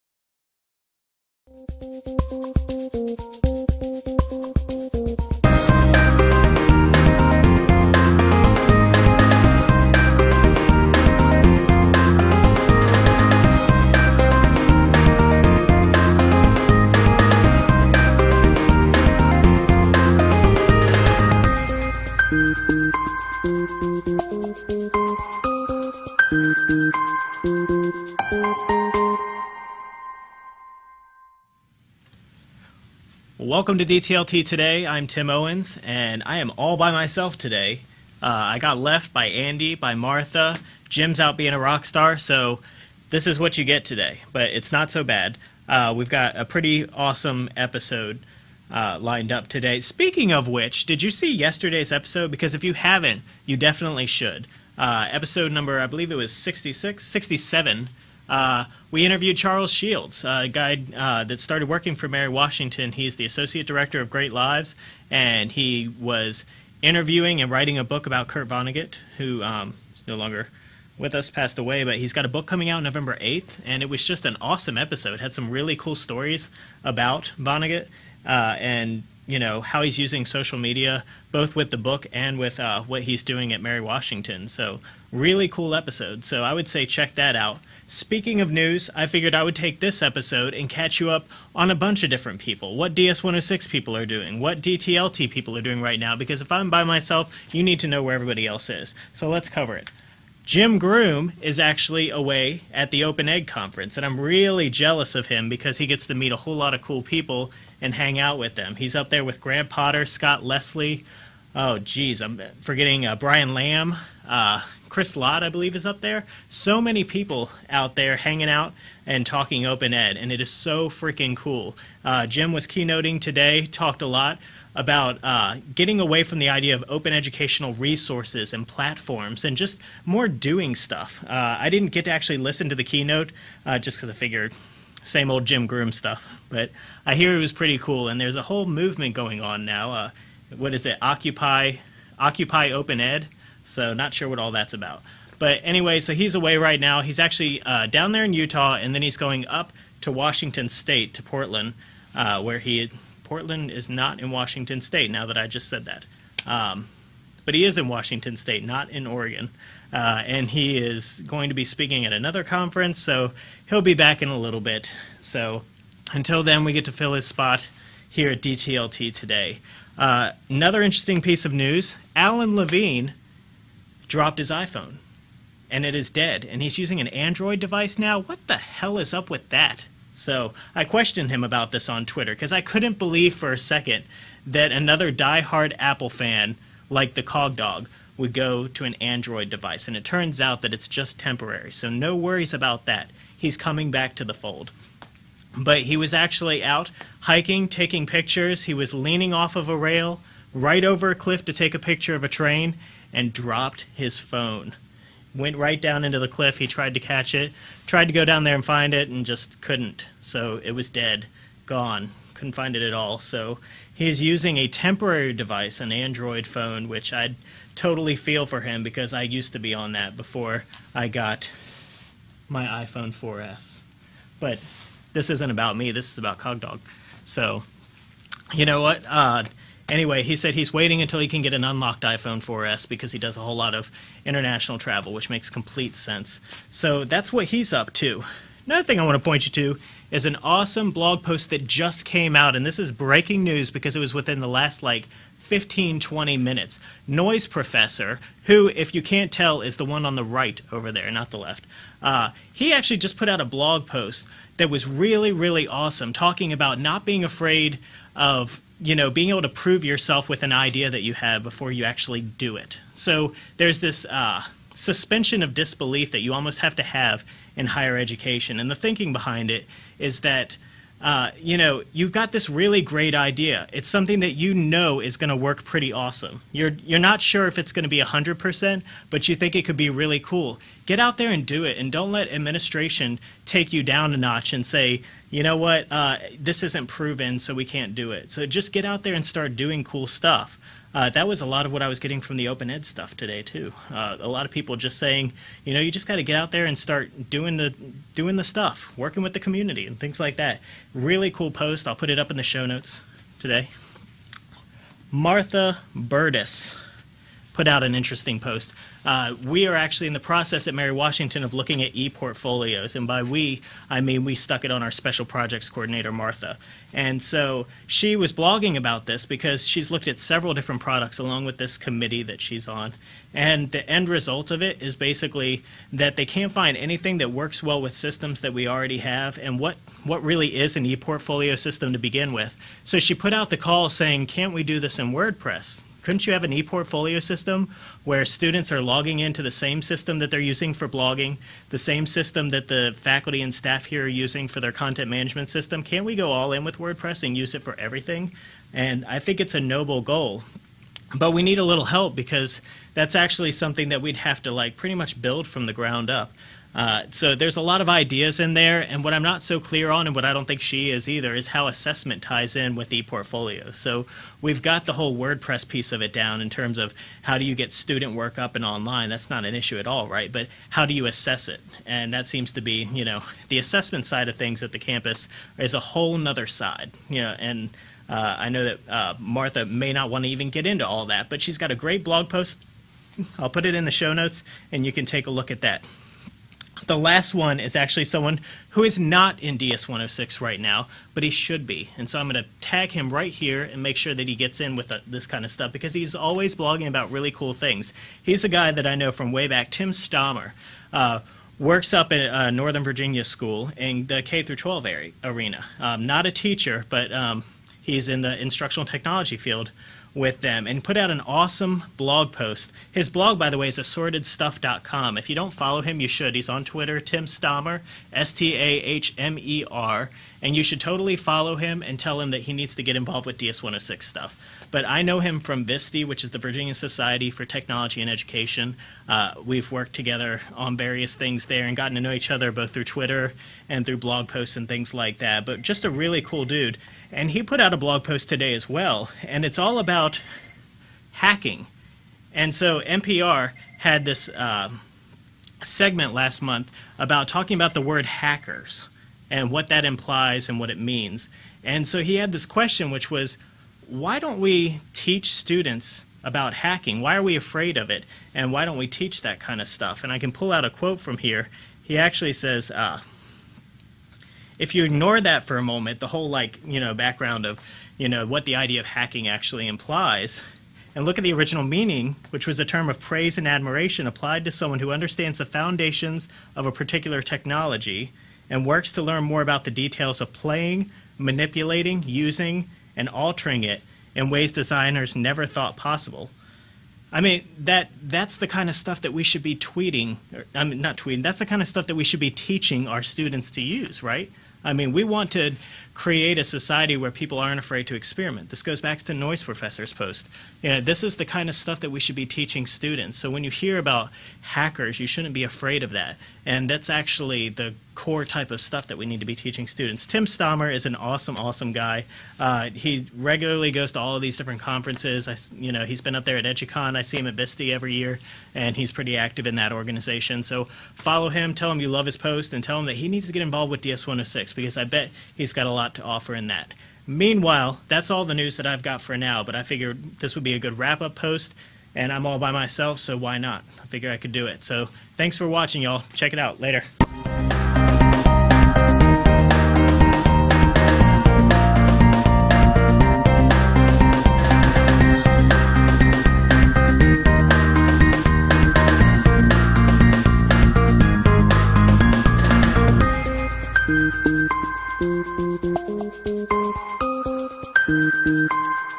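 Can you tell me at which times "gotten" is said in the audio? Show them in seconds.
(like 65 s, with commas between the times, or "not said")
431 s.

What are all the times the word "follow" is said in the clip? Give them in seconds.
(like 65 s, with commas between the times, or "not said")
415 s, 421 s, 520 s.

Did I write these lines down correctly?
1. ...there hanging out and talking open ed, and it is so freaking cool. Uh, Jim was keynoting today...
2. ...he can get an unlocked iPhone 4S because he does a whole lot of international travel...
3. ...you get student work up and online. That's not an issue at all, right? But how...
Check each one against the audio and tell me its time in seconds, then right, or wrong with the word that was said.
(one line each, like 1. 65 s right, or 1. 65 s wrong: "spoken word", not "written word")
1. 117 s right
2. 231 s right
3. 367 s right.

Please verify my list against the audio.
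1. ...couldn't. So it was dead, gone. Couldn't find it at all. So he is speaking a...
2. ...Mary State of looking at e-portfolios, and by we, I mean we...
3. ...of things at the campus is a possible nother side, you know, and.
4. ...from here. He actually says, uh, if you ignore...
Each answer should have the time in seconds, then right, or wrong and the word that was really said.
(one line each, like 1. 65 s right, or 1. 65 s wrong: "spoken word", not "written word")
1. 209 s wrong: "using", not "speaking"
2. 310 s wrong: "Washington", not "State"
3. 374 s wrong: "whole", not "possible"
4. 461 s right.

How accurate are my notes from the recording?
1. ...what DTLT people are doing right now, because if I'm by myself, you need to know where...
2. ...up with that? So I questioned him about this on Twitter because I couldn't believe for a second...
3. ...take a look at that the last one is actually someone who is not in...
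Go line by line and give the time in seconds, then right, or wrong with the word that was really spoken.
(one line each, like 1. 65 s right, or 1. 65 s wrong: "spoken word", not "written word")
1. 94 s right
2. 179 s right
3. 385 s right.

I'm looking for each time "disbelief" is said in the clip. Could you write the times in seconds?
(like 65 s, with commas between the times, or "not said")
265 s.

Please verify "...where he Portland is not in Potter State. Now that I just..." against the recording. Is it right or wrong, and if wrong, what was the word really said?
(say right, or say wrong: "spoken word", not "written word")
wrong: "Washington", not "Potter".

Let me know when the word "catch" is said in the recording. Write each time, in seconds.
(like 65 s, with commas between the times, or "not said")
90 s, 206 s.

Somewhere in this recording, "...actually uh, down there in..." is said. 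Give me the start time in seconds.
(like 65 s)
147 s.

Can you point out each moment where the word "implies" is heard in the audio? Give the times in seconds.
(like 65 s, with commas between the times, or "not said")
449 s, 469 s.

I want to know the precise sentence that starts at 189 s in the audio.
And it turns out that it's just temporary.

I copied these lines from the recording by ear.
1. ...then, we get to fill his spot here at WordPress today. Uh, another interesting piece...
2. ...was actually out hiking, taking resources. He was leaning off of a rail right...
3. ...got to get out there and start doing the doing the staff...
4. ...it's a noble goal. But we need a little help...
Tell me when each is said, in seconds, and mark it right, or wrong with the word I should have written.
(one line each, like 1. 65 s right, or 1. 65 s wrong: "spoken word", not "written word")
1. 166 s wrong: "DTLT", not "WordPress"
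2. 195 s wrong: "pictures", not "resources"
3. 296 s wrong: "stuff", not "staff"
4. 349 s right.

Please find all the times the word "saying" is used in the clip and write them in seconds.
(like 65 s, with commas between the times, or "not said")
294 s, 333 s.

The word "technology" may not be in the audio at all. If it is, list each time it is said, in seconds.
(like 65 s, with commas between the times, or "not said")
408 s, 427 s, 477 s.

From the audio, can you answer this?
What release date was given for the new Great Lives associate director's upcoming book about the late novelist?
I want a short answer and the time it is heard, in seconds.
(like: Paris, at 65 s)
November 8th, at 72 s.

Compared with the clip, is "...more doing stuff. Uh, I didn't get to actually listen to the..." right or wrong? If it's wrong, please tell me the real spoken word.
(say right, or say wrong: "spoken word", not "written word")
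right.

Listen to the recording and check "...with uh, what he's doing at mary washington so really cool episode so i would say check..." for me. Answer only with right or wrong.
right.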